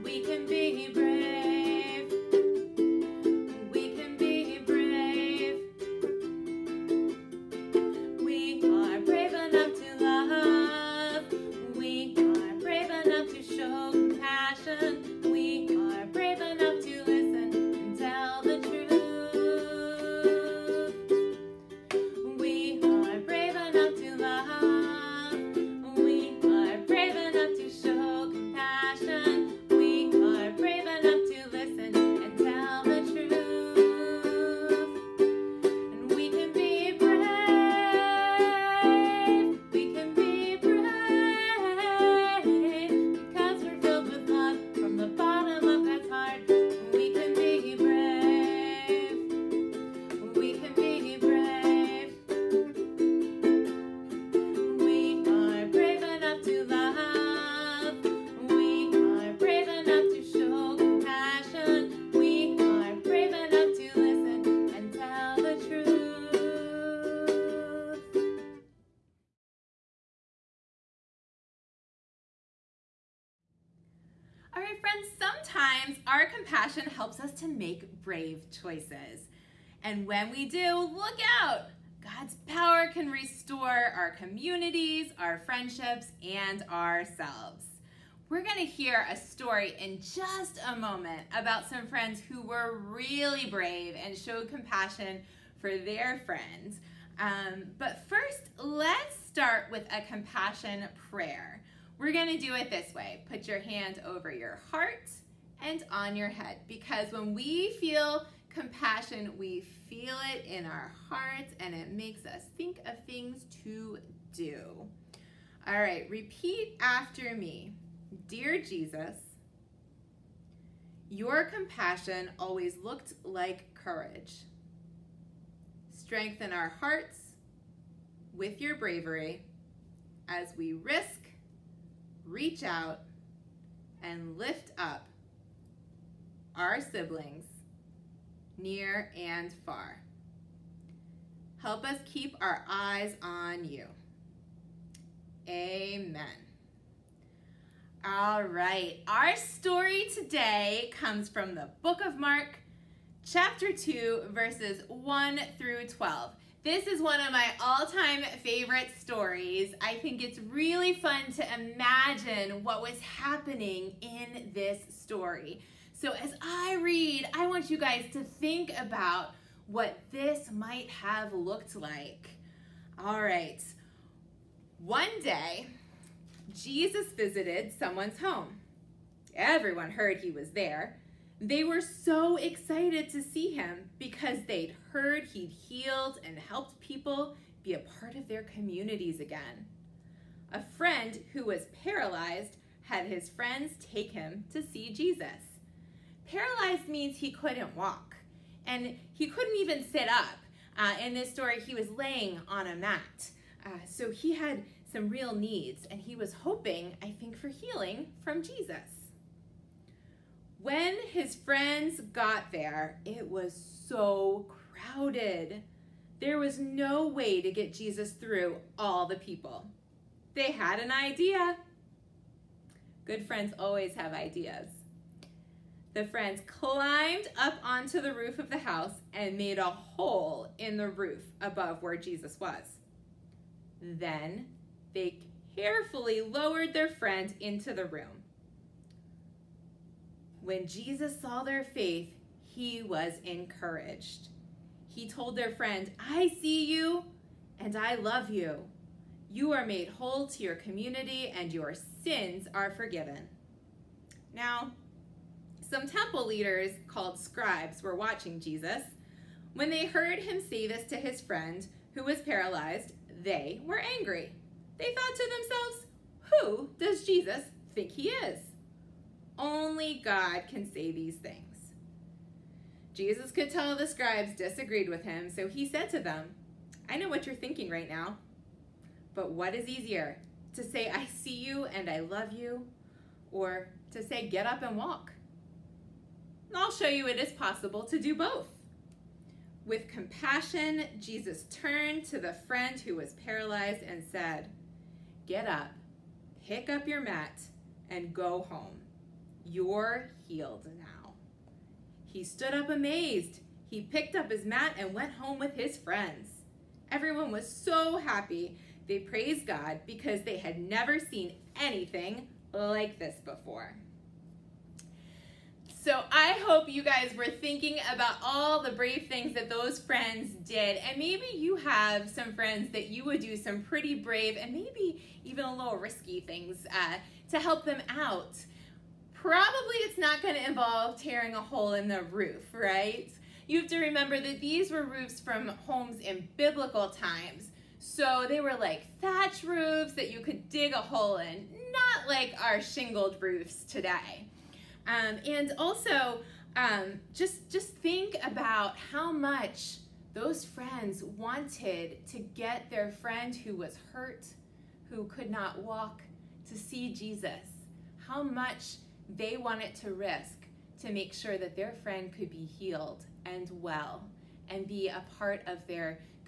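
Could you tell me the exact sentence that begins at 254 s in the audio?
Now, some temple leaders, called scribes, were watching Jesus.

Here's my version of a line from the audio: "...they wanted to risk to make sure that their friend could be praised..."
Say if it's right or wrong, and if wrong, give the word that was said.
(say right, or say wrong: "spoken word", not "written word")
wrong: "healed", not "praised".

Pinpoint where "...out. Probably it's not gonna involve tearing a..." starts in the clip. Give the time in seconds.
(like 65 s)
327 s.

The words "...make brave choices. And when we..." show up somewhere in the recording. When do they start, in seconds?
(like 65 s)
77 s.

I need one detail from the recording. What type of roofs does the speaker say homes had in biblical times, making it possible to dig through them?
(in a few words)
Thatch roofs.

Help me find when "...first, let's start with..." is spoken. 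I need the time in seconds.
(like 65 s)
98 s.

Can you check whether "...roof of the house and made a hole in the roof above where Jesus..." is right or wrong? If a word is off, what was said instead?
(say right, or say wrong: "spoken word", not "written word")
right.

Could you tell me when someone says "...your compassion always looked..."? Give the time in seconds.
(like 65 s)
121 s.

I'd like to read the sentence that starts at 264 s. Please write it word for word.
They thought to themselves, who does Jesus think he is?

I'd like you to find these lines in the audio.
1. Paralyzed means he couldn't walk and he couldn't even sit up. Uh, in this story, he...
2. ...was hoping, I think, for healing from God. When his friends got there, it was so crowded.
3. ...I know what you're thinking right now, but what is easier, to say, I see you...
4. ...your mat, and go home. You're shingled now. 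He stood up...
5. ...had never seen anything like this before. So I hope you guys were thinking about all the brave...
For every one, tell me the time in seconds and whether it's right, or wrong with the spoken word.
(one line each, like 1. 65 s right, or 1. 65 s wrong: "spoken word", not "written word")
1. 196 s right
2. 206 s wrong: "Jesus", not "God"
3. 276 s right
4. 296 s wrong: "healed", not "shingled"
5. 310 s right.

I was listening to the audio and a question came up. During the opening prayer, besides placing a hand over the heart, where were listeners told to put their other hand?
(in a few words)
On your head.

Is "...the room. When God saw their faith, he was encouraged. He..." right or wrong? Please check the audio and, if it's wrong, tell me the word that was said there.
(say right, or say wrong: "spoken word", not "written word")
wrong: "Jesus", not "God".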